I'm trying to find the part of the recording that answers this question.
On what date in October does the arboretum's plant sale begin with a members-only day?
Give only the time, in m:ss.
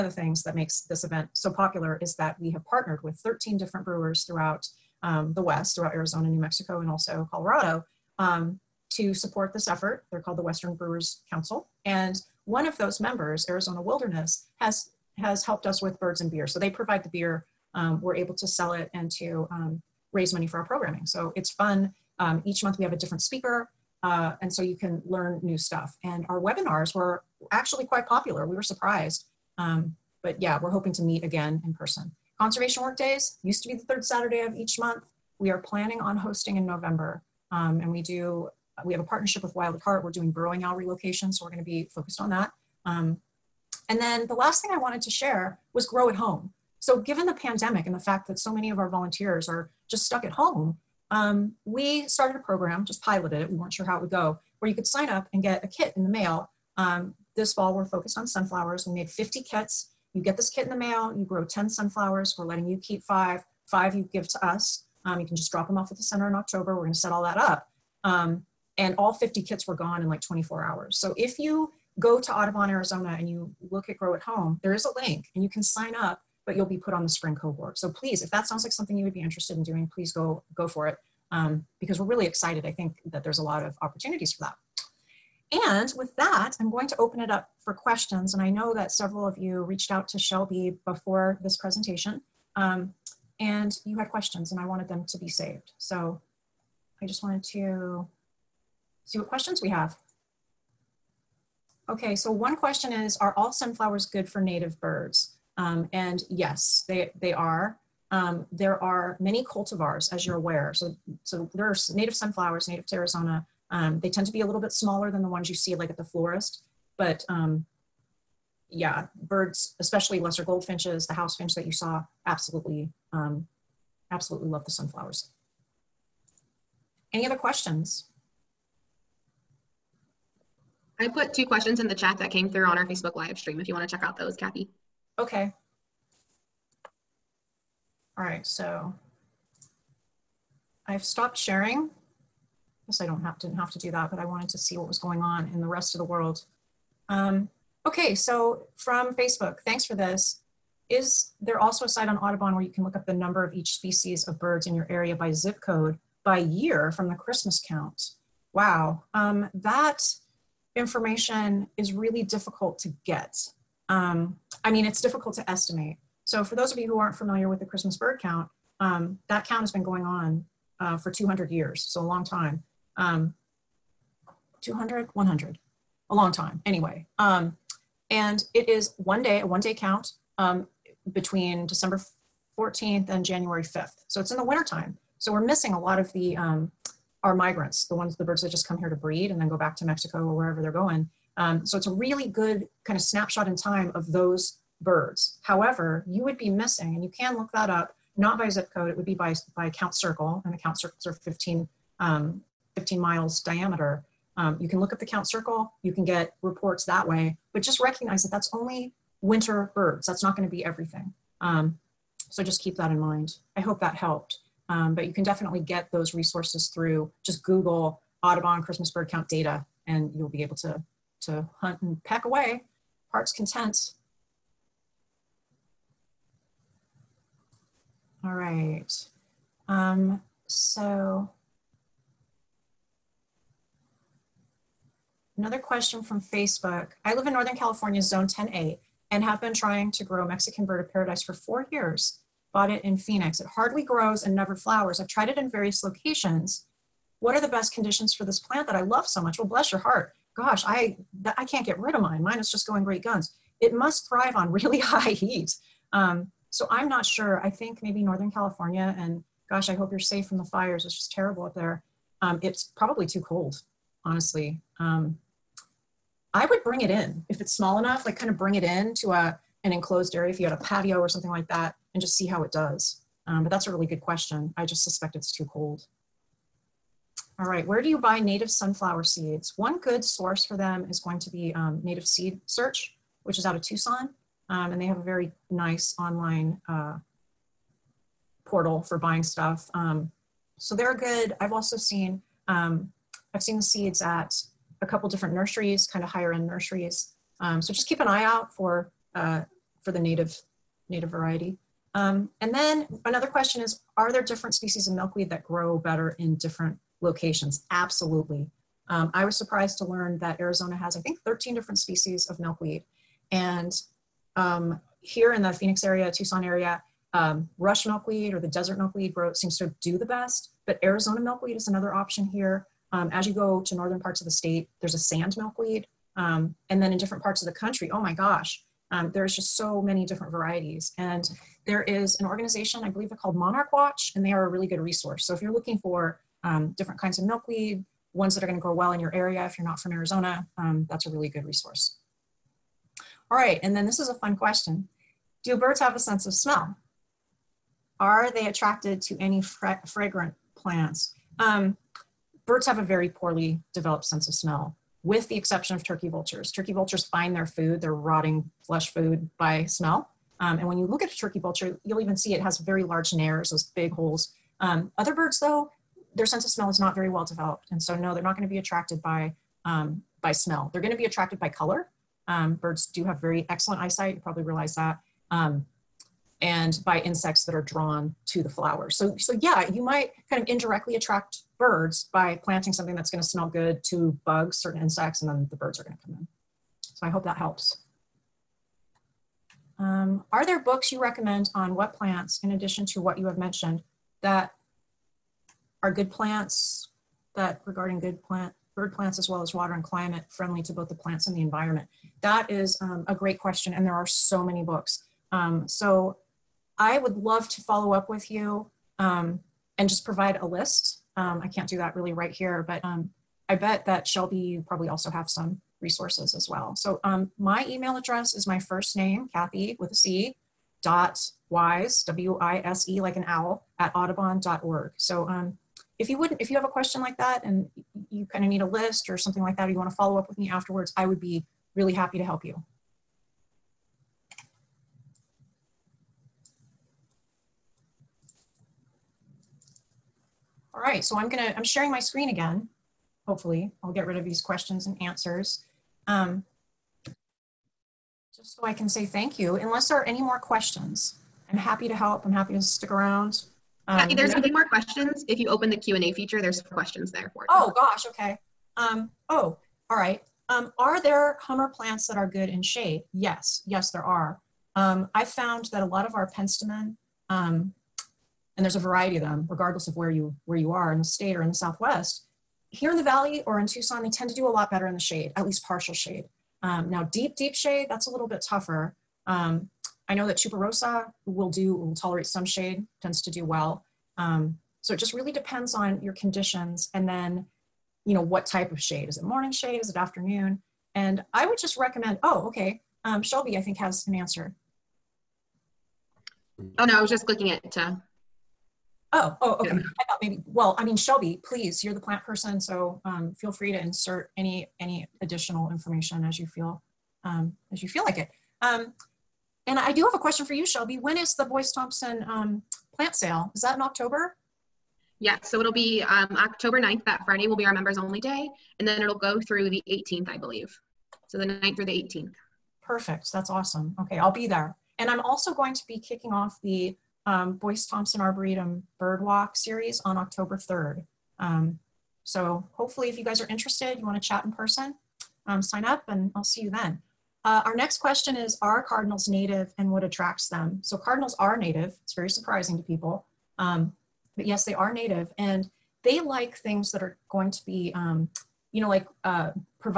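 8:36.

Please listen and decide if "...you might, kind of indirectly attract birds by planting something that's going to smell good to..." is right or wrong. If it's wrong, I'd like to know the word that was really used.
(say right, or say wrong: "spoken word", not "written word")
right.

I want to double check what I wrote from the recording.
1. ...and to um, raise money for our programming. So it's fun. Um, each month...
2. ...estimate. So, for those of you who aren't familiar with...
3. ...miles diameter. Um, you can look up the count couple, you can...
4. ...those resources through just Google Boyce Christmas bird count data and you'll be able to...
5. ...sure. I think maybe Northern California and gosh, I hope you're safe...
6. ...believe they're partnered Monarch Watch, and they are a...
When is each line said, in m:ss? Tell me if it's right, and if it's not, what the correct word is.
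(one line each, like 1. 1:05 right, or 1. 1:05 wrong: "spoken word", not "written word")
1. 0:18 right
2. 2:45 right
3. 3:22 wrong: "circle", not "couple"
4. 3:35 wrong: "Audubon", not "Boyce"
5. 4:17 right
6. 5:32 wrong: "called", not "partnered".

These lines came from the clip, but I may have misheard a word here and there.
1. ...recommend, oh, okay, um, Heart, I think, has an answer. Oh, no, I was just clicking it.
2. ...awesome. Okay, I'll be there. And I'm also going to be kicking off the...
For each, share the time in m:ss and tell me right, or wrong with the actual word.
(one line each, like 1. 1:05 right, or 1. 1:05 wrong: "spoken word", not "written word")
1. 8:11 wrong: "Shelby", not "Heart"
2. 8:43 right.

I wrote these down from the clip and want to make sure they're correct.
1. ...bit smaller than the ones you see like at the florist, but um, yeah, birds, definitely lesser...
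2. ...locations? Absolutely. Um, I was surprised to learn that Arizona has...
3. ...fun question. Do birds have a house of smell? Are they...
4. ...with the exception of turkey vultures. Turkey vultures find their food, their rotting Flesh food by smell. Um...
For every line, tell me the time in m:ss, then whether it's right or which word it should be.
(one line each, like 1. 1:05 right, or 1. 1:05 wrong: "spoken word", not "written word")
1. 1:54 wrong: "especially", not "definitely"
2. 5:07 right
3. 5:44 wrong: "sense", not "house"
4. 5:55 right.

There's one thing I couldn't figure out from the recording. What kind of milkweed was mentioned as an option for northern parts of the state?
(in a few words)
Sand milkweed.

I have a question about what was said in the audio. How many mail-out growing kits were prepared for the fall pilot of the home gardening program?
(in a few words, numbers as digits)
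50.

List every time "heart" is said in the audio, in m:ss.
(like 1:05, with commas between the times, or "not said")
0:39, 3:43, 4:09.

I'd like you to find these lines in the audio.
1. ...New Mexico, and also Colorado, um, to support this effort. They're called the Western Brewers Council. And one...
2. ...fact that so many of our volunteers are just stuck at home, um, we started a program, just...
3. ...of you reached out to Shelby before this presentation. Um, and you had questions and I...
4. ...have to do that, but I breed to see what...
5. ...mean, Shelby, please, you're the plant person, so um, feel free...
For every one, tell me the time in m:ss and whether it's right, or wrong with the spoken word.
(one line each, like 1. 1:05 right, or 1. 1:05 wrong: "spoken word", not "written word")
1. 0:06 right
2. 0:47 right
3. 1:29 right
4. 2:23 wrong: "wanted", not "breed"
5. 8:20 right.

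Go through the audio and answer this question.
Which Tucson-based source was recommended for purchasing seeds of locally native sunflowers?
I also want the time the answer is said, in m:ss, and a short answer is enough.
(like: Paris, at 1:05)
Native Seed Search, at 4:41.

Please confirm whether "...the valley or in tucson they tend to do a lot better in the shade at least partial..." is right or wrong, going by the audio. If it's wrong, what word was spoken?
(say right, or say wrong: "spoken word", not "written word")
right.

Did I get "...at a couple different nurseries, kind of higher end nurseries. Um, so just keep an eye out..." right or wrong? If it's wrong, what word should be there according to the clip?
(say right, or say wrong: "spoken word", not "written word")
right.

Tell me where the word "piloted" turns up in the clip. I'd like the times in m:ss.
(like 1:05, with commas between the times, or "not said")
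0:53.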